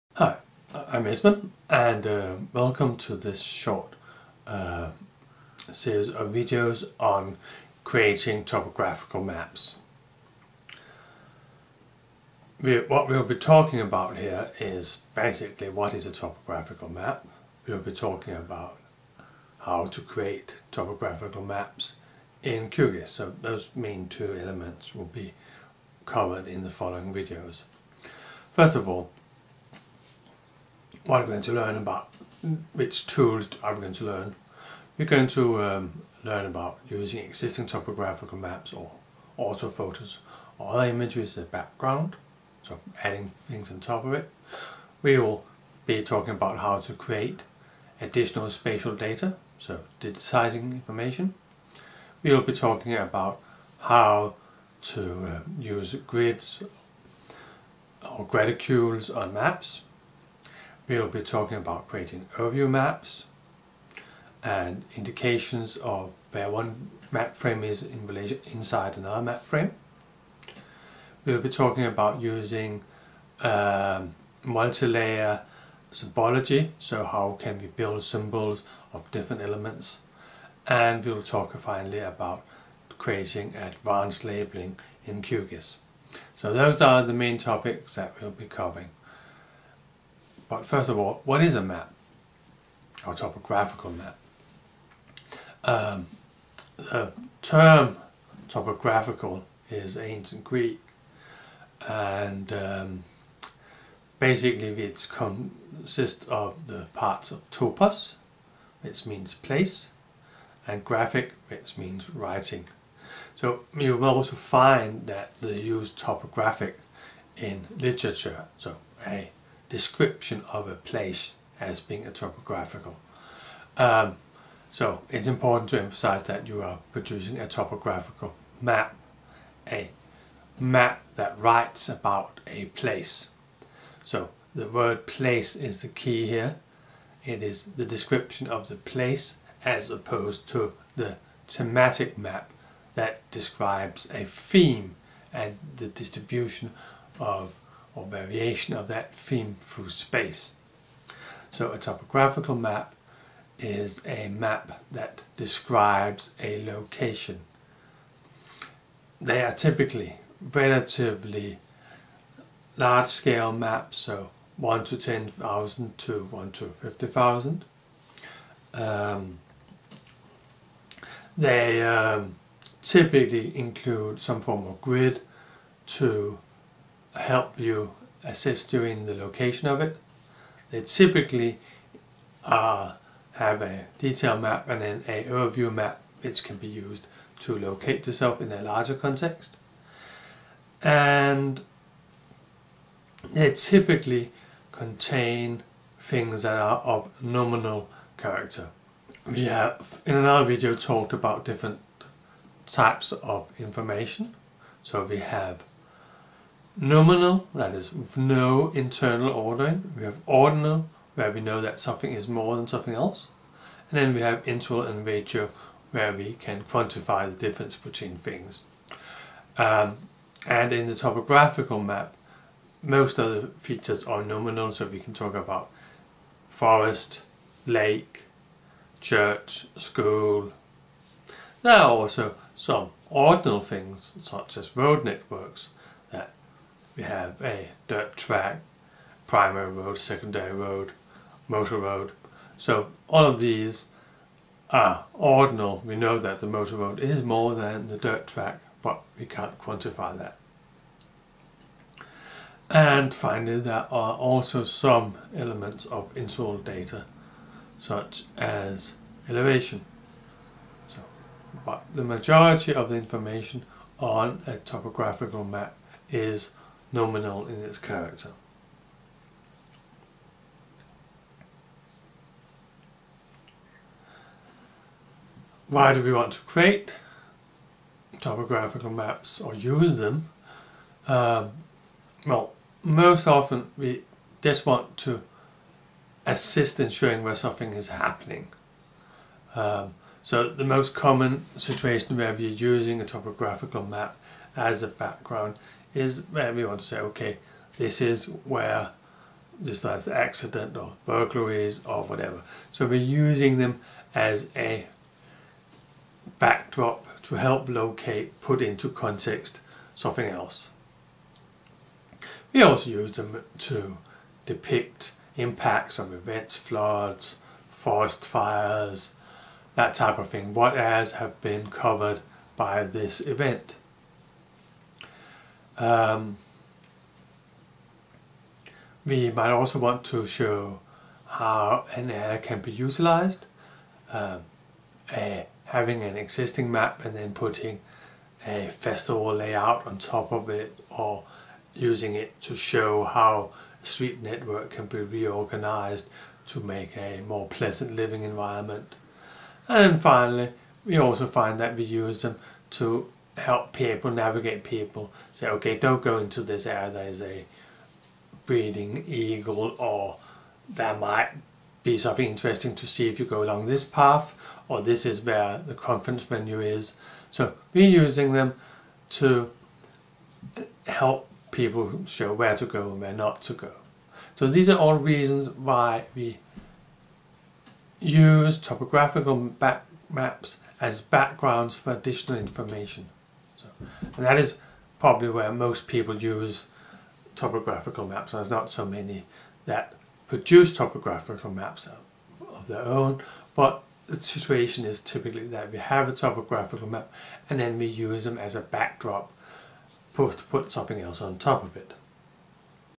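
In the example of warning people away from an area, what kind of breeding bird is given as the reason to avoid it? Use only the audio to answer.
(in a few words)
eagle.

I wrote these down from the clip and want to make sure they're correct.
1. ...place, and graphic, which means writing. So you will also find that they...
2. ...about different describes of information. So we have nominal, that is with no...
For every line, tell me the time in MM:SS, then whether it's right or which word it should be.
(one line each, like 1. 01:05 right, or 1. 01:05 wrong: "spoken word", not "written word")
1. 01:49 right
2. 03:21 wrong: "types", not "describes".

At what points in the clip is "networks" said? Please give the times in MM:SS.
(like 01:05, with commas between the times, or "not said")
03:55, 05:44.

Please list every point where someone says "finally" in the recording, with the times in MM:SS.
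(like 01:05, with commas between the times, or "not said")
01:21, 04:13, 05:49.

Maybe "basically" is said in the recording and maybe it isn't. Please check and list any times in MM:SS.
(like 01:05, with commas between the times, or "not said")
00:15, 01:44.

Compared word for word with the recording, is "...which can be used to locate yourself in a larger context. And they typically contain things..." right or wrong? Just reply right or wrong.
right.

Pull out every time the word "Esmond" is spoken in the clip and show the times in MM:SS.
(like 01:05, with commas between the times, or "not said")
00:01.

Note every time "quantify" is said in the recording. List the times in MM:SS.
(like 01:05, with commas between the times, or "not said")
03:36, 04:09.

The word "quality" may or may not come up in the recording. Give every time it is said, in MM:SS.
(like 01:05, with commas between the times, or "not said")
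not said.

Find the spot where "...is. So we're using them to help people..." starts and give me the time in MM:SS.
06:06.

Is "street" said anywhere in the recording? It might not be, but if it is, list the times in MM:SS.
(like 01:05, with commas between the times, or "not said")
05:43.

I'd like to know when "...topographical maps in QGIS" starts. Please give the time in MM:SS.
00:20.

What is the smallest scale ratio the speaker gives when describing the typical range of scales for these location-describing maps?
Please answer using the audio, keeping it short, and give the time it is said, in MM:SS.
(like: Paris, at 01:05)
1 to 50,000, at 02:46.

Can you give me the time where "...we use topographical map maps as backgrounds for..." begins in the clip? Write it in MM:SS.
06:16.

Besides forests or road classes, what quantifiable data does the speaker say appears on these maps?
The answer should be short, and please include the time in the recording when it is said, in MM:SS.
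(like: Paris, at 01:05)
elevation, at 04:19.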